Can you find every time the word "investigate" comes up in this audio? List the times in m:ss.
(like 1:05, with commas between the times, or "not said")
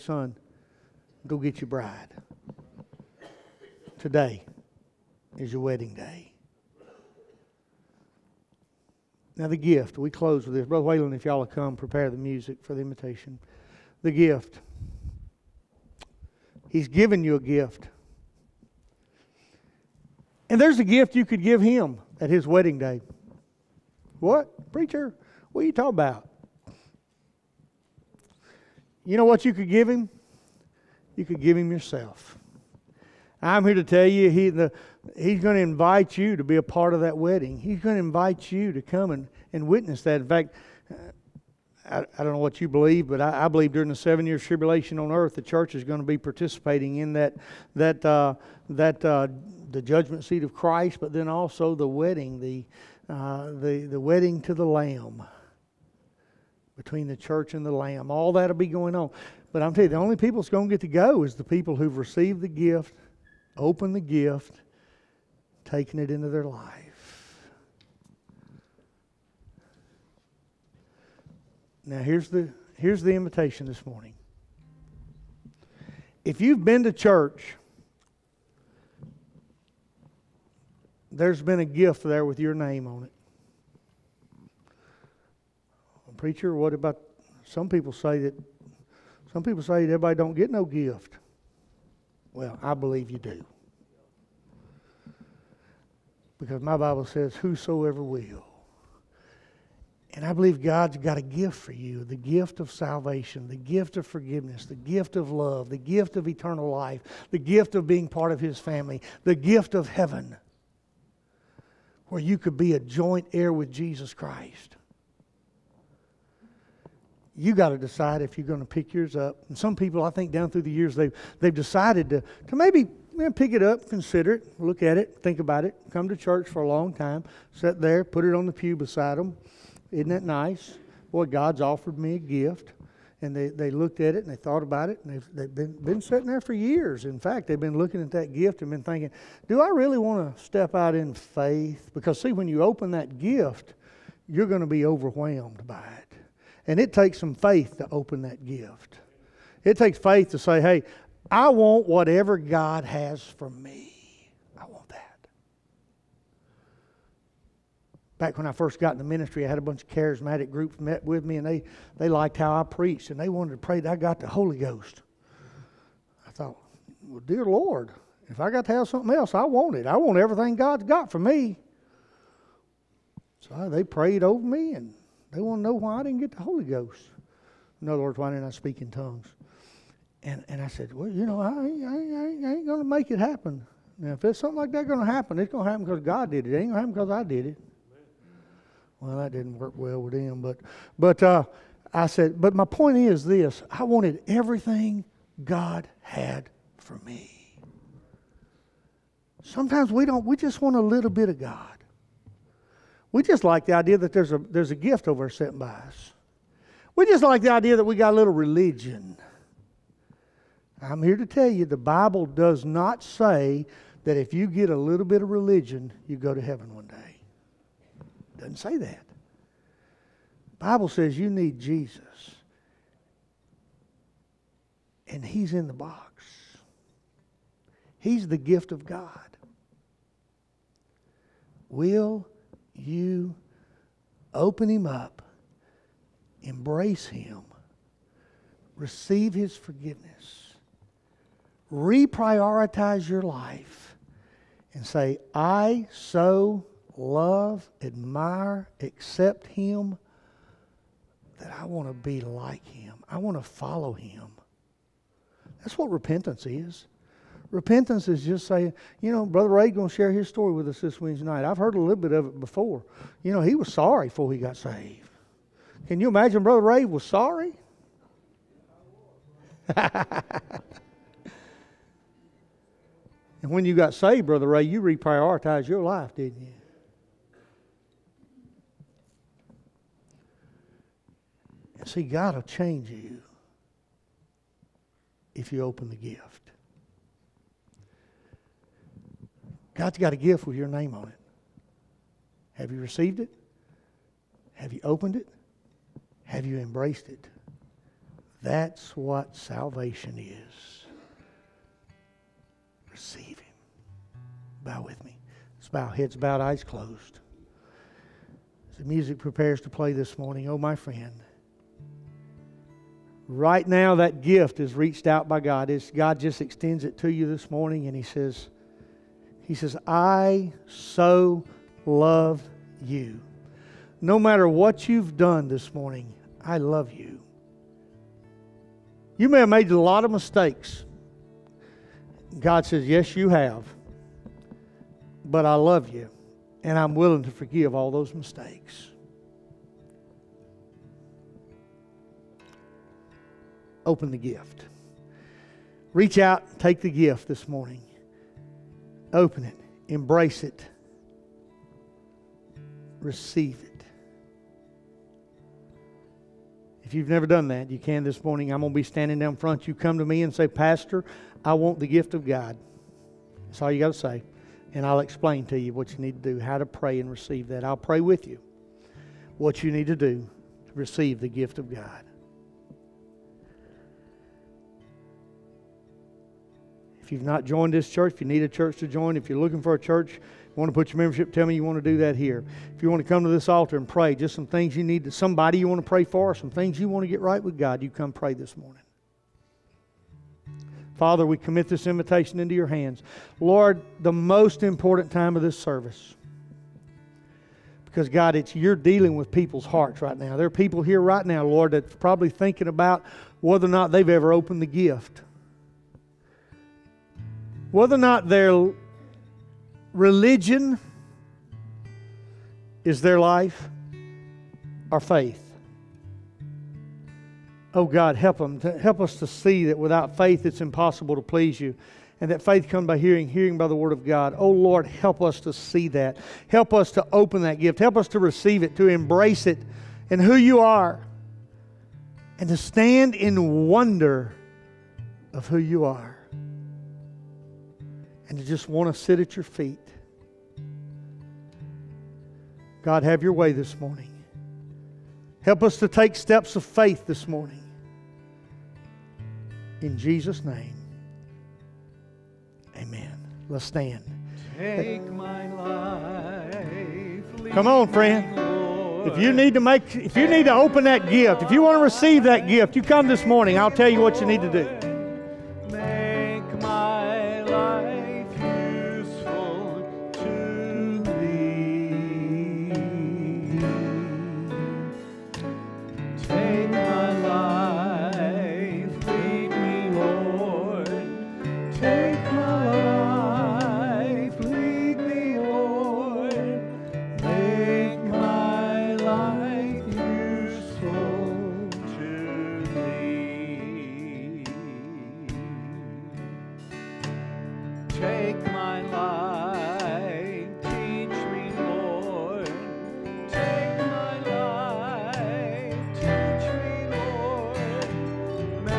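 not said.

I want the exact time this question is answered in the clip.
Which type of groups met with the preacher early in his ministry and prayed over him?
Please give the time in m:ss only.
2:39.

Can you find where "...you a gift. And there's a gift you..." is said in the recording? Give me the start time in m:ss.
0:17.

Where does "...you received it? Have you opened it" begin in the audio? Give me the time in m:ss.
4:52.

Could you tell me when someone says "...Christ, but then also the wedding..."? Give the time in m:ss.
0:50.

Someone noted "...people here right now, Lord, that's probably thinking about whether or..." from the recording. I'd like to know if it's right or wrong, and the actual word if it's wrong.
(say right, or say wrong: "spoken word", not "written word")
right.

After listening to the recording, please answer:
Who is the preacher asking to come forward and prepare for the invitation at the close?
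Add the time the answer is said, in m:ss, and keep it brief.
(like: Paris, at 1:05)
Brother Whalen, at 0:10.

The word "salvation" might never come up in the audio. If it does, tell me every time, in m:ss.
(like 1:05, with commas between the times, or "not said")
1:42, 4:59.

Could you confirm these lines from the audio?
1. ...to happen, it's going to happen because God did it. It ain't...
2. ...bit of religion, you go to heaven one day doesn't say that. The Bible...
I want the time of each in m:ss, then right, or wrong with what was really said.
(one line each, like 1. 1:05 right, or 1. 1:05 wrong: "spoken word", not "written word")
1. 3:05 right
2. 3:35 right.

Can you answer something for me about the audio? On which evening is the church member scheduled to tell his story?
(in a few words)
Wednesday night.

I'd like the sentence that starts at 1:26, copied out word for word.
Preacher, what about some people say that some people say that everybody don't get no gift.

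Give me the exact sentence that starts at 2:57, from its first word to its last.
In other words, why didn't I speak in tongues?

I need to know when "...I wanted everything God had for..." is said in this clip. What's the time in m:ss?
3:13.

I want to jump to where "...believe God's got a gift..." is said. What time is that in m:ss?
1:40.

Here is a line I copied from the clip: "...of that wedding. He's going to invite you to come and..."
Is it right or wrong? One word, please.
right.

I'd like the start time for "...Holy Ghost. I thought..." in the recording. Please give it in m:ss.
2:44.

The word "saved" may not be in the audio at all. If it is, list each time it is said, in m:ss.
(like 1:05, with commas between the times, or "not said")
4:24, 4:33.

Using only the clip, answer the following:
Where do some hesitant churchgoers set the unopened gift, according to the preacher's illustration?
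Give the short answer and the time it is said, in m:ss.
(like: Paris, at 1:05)
on the pew, at 2:08.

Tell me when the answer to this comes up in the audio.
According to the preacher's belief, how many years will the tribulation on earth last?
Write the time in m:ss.
0:43.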